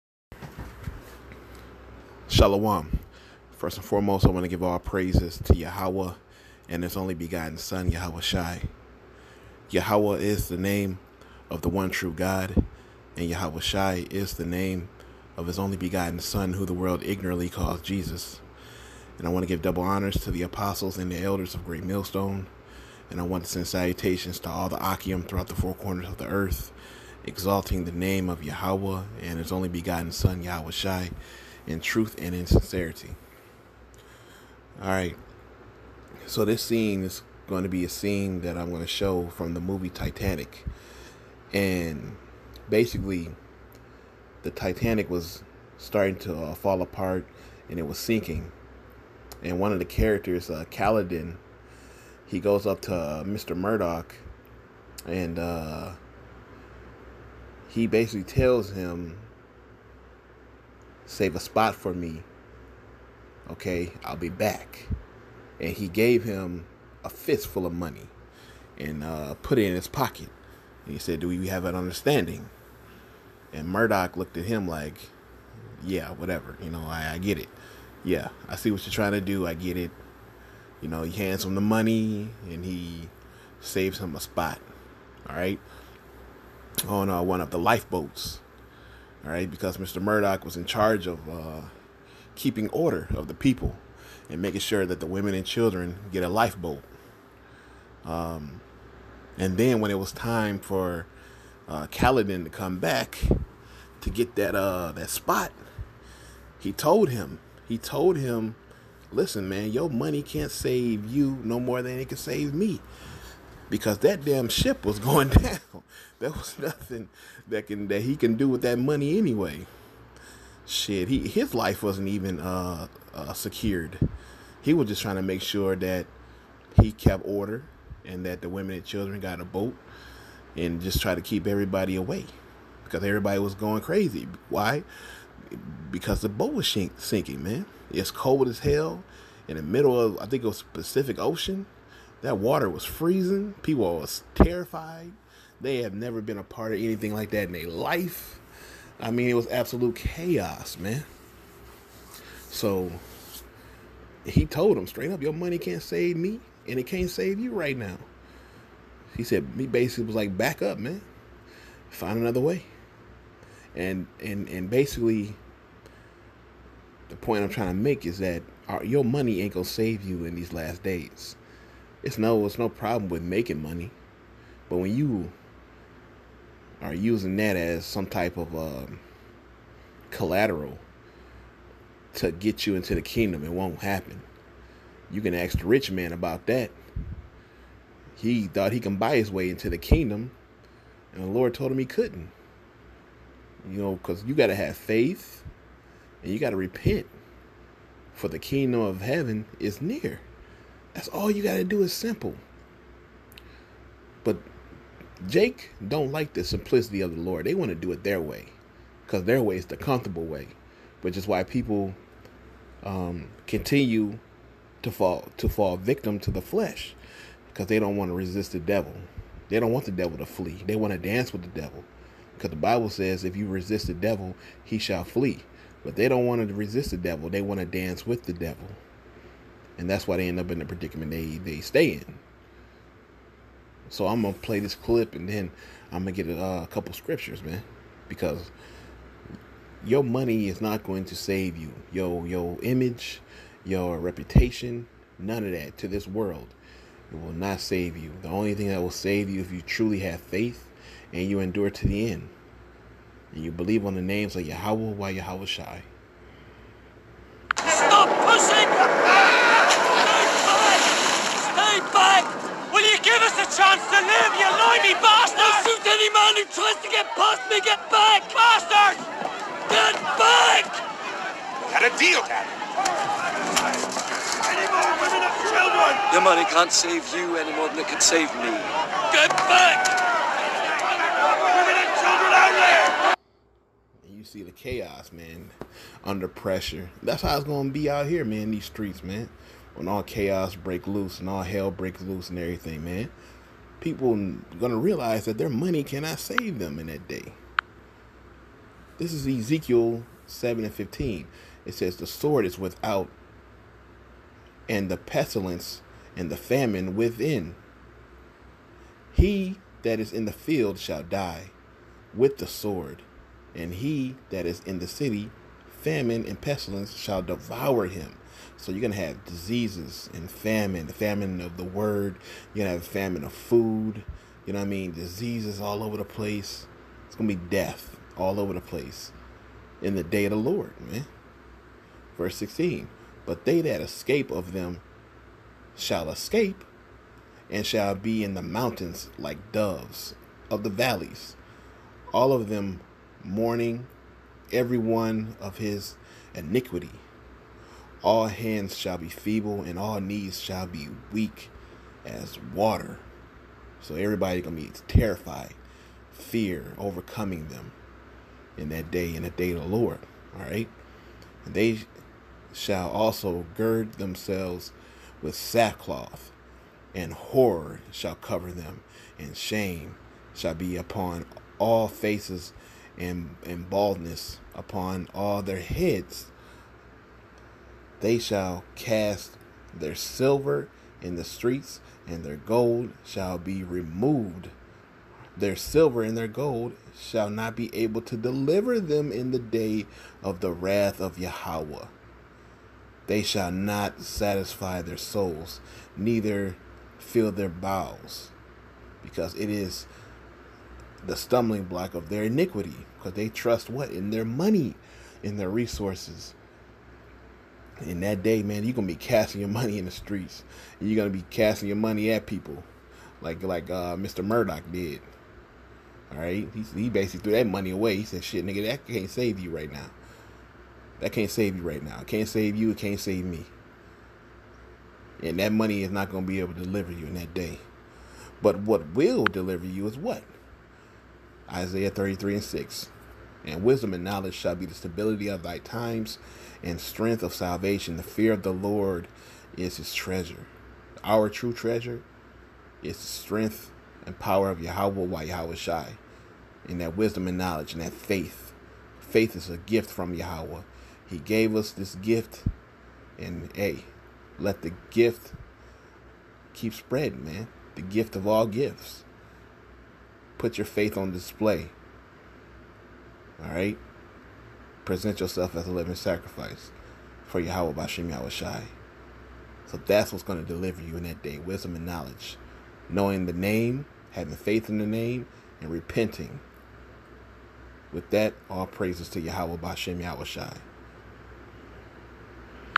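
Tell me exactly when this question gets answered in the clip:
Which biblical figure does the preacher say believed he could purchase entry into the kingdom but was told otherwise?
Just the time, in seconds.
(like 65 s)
185 s.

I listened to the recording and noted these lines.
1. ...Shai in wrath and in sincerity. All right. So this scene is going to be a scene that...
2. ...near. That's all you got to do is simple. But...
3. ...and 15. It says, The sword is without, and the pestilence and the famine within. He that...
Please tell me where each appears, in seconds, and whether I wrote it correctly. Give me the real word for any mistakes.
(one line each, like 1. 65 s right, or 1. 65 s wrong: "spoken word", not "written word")
1. 30 s wrong: "truth", not "wrath"
2. 199 s right
3. 300 s right.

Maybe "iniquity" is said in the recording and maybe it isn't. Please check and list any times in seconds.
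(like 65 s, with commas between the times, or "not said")
346 s, 402 s.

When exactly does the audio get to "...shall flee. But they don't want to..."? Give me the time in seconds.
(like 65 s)
224 s.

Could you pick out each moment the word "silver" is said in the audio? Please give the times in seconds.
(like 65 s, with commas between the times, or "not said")
379 s, 385 s.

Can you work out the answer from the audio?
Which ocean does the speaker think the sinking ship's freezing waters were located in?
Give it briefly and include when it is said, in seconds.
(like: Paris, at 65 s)
Pacific Ocean, at 140 s.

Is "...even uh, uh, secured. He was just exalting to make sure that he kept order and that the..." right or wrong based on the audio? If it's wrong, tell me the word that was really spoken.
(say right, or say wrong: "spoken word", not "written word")
wrong: "trying", not "exalting".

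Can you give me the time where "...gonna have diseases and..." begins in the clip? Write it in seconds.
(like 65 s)
318 s.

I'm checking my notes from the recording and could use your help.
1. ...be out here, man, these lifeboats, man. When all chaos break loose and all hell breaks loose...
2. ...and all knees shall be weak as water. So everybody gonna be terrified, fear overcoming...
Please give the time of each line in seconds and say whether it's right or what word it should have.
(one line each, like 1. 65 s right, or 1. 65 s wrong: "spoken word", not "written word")
1. 287 s wrong: "streets", not "lifeboats"
2. 349 s right.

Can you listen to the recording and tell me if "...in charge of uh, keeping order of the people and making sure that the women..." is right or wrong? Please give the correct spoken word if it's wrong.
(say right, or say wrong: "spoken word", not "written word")
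right.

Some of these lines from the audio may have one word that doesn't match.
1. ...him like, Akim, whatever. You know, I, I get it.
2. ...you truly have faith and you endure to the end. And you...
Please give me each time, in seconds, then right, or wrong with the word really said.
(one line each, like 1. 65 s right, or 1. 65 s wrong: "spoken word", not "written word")
1. 74 s wrong: "Yeah", not "Akim"
2. 249 s right.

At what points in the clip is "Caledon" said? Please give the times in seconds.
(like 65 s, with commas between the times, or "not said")
50 s, 101 s.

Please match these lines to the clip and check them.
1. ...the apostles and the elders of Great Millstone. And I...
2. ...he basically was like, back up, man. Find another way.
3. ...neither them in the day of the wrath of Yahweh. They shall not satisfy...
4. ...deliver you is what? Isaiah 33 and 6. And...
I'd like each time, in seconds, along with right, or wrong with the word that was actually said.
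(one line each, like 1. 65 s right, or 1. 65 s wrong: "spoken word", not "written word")
1. 20 s right
2. 159 s right
3. 388 s wrong: "deliver", not "neither"
4. 429 s right.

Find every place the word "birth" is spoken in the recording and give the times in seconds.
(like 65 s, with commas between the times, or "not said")
not said.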